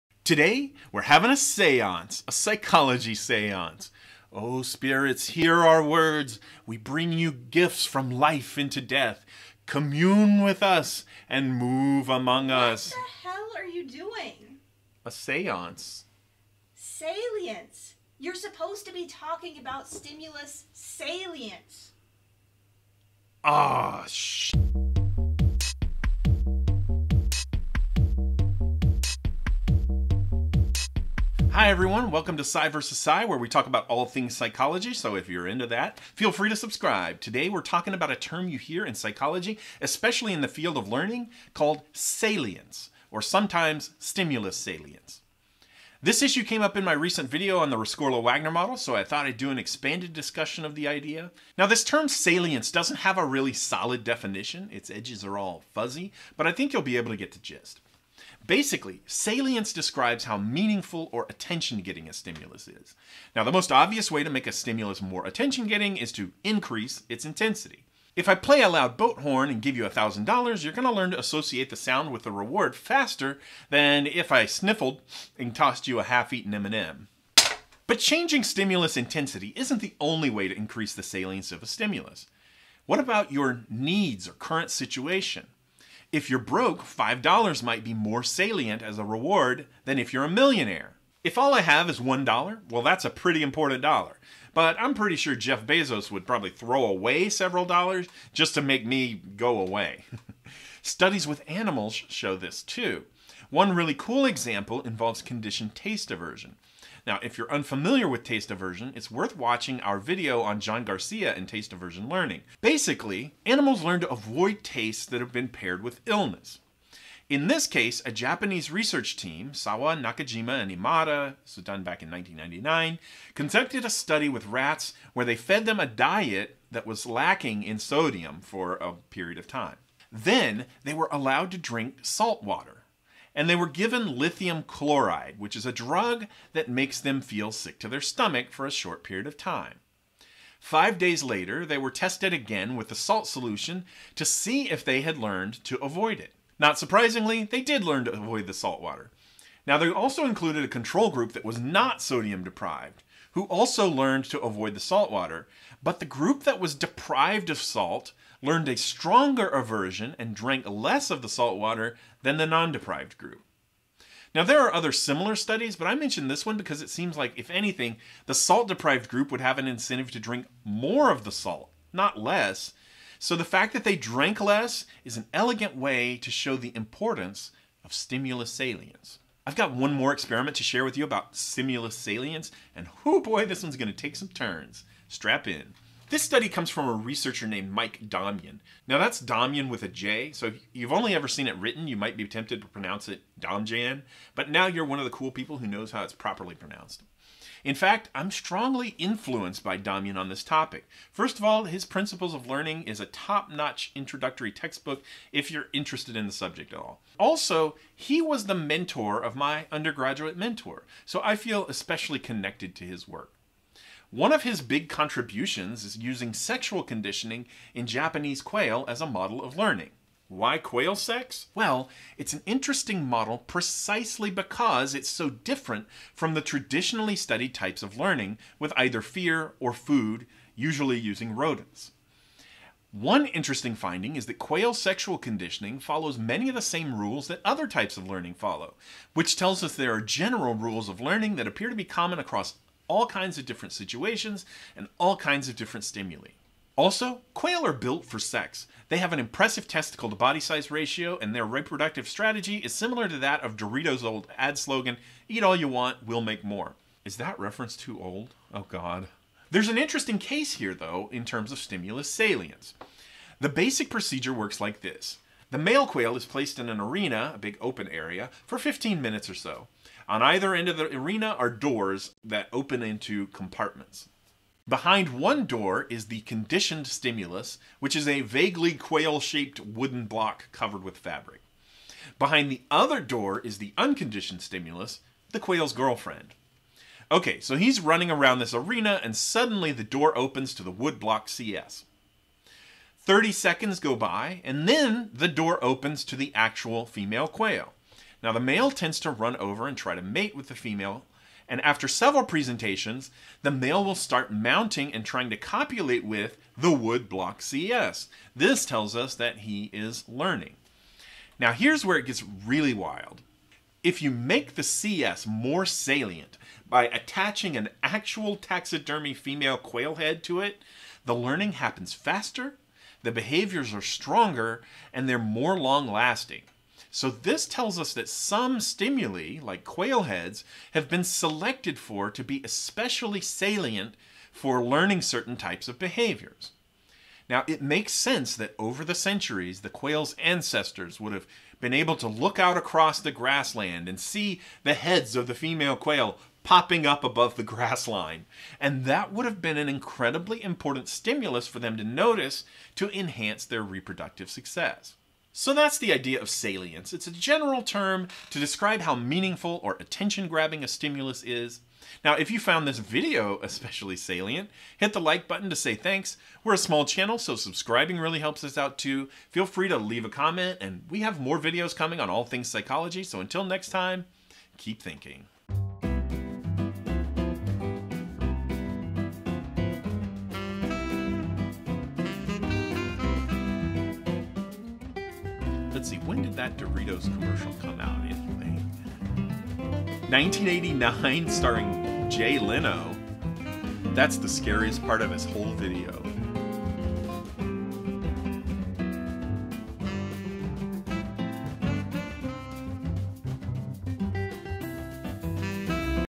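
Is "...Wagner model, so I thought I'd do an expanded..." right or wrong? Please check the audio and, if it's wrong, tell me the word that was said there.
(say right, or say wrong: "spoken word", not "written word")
right.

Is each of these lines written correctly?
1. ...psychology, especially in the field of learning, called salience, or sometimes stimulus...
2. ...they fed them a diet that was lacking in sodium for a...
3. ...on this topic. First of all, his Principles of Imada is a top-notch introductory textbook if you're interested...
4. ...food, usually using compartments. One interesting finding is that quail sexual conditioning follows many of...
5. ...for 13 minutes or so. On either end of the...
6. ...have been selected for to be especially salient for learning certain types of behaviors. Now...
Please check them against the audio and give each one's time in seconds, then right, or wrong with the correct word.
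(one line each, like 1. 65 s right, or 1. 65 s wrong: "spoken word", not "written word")
1. 38 s right
2. 125 s right
3. 200 s wrong: "Learning", not "Imada"
4. 229 s wrong: "rodents", not "compartments"
5. 268 s wrong: "15", not "13"
6. 330 s right.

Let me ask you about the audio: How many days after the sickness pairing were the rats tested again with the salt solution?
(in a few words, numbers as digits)
Five.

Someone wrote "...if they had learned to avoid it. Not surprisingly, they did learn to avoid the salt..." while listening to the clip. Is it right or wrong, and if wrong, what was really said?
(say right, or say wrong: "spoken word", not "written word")
right.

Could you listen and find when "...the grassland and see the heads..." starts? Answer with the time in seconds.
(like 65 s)
342 s.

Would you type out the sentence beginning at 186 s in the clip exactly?
This study comes from a researcher named Mike Domjan.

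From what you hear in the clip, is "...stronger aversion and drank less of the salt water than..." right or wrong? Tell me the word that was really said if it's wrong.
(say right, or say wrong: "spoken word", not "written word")
right.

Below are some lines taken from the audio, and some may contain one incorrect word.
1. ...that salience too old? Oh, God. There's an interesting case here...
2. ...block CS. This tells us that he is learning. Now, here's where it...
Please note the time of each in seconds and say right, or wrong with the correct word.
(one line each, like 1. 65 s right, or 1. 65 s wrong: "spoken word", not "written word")
1. 257 s wrong: "reference", not "salience"
2. 307 s right.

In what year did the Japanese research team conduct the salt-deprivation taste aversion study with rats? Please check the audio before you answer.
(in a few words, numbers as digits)
1999.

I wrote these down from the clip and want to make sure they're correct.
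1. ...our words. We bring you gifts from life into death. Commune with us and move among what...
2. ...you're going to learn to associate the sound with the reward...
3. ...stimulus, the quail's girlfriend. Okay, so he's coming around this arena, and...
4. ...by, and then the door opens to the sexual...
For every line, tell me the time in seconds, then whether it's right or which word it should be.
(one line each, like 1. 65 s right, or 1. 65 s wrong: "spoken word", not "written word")
1. 5 s right
2. 70 s right
3. 284 s wrong: "running", not "coming"
4. 293 s wrong: "actual", not "sexual".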